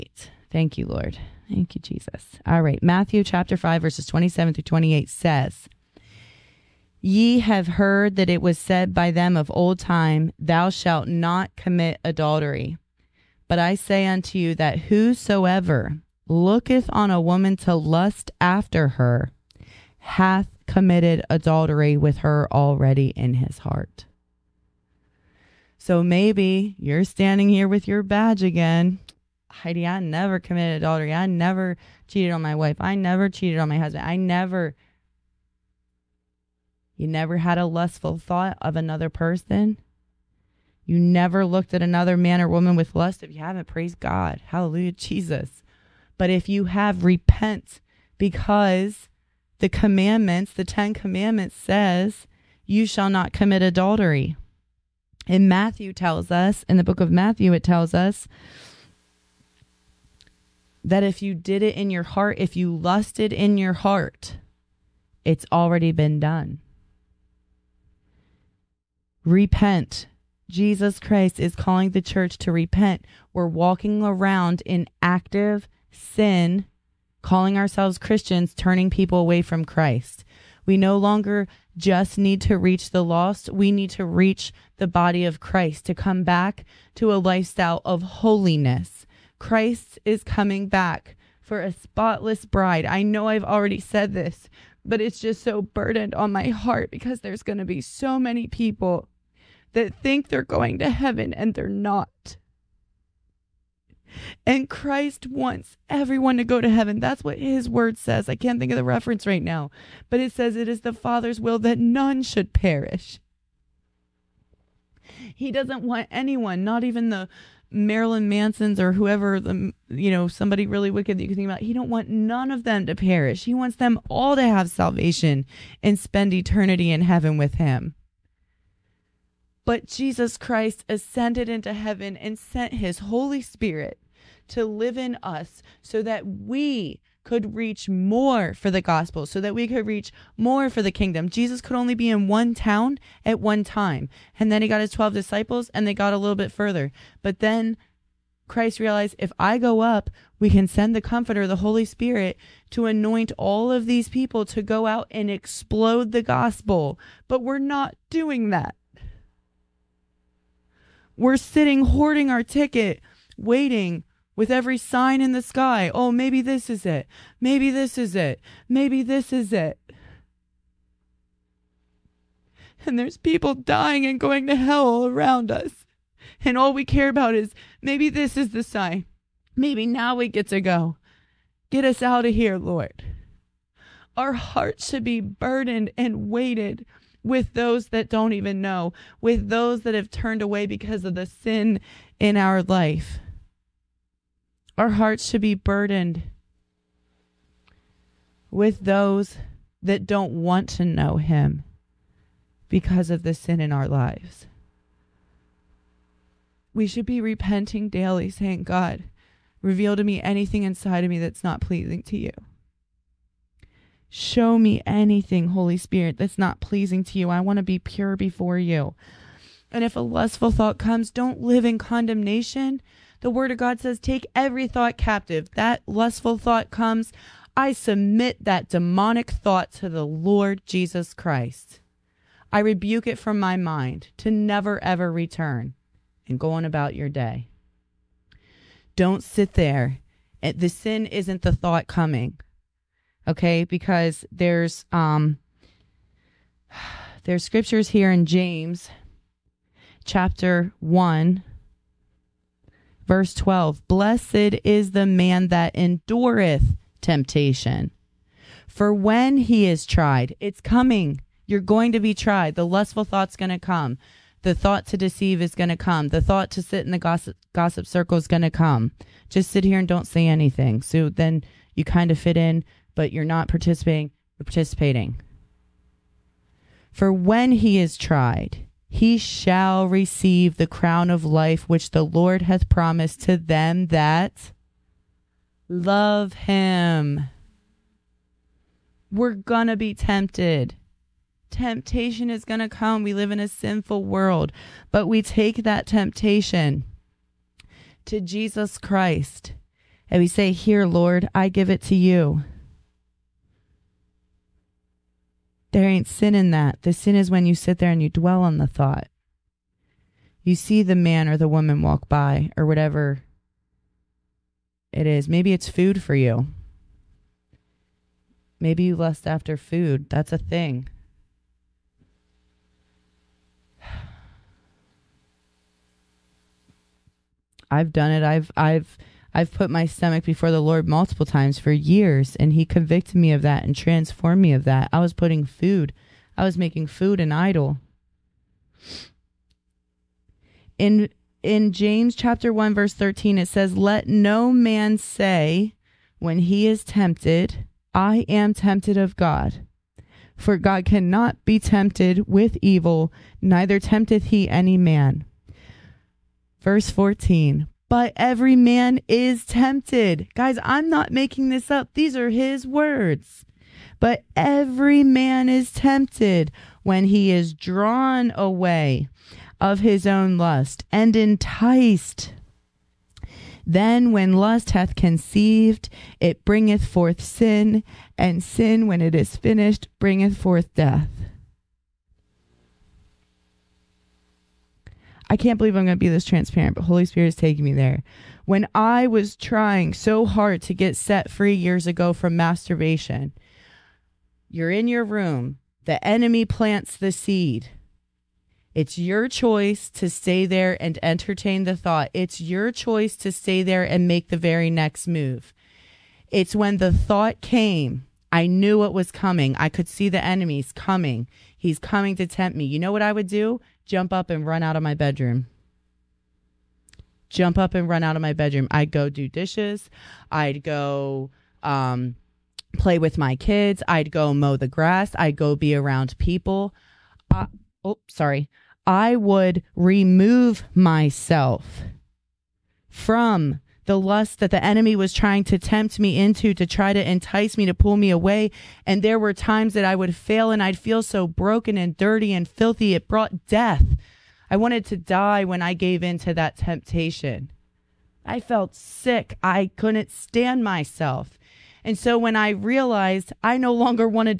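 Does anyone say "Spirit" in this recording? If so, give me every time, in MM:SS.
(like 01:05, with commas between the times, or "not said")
02:13, 02:31, 03:35, 06:27.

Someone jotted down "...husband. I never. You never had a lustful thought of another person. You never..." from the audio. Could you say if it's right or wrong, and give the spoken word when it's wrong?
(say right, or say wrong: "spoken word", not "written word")
right.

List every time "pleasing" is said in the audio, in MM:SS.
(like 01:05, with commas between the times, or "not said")
03:31, 03:36.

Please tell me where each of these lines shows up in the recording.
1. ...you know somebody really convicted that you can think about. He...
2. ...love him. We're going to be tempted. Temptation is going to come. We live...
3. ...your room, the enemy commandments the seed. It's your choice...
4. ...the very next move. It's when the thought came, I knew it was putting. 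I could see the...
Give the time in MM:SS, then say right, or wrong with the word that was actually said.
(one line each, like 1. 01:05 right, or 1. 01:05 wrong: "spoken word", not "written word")
1. 01:59 wrong: "wicked", not "convicted"
2. 04:45 right
3. 06:34 wrong: "plants", not "commandments"
4. 06:44 wrong: "coming", not "putting".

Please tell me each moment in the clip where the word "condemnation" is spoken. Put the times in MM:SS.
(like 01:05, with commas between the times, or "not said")
03:41.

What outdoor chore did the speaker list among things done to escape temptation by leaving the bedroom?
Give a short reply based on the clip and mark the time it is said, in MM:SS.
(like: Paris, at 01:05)
mow the grass, at 07:04.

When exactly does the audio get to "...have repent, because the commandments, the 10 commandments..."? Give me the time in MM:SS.
00:46.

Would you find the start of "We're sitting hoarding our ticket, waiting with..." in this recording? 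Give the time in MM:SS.
02:41.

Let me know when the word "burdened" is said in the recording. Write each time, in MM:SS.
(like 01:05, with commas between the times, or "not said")
01:35, 03:05, 03:15.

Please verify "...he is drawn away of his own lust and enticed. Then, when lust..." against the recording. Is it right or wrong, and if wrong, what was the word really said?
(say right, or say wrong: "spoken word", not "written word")
right.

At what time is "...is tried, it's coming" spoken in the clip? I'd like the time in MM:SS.
04:19.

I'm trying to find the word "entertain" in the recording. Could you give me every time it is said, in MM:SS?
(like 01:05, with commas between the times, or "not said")
06:41.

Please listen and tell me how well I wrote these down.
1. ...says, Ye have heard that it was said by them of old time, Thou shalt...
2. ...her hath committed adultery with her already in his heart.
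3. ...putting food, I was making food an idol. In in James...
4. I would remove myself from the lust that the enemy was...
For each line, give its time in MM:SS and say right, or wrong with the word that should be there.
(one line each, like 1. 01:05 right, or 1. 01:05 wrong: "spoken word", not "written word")
1. 00:05 right
2. 00:18 right
3. 05:35 right
4. 07:08 right.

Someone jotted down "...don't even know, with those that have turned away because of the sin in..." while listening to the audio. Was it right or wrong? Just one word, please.
right.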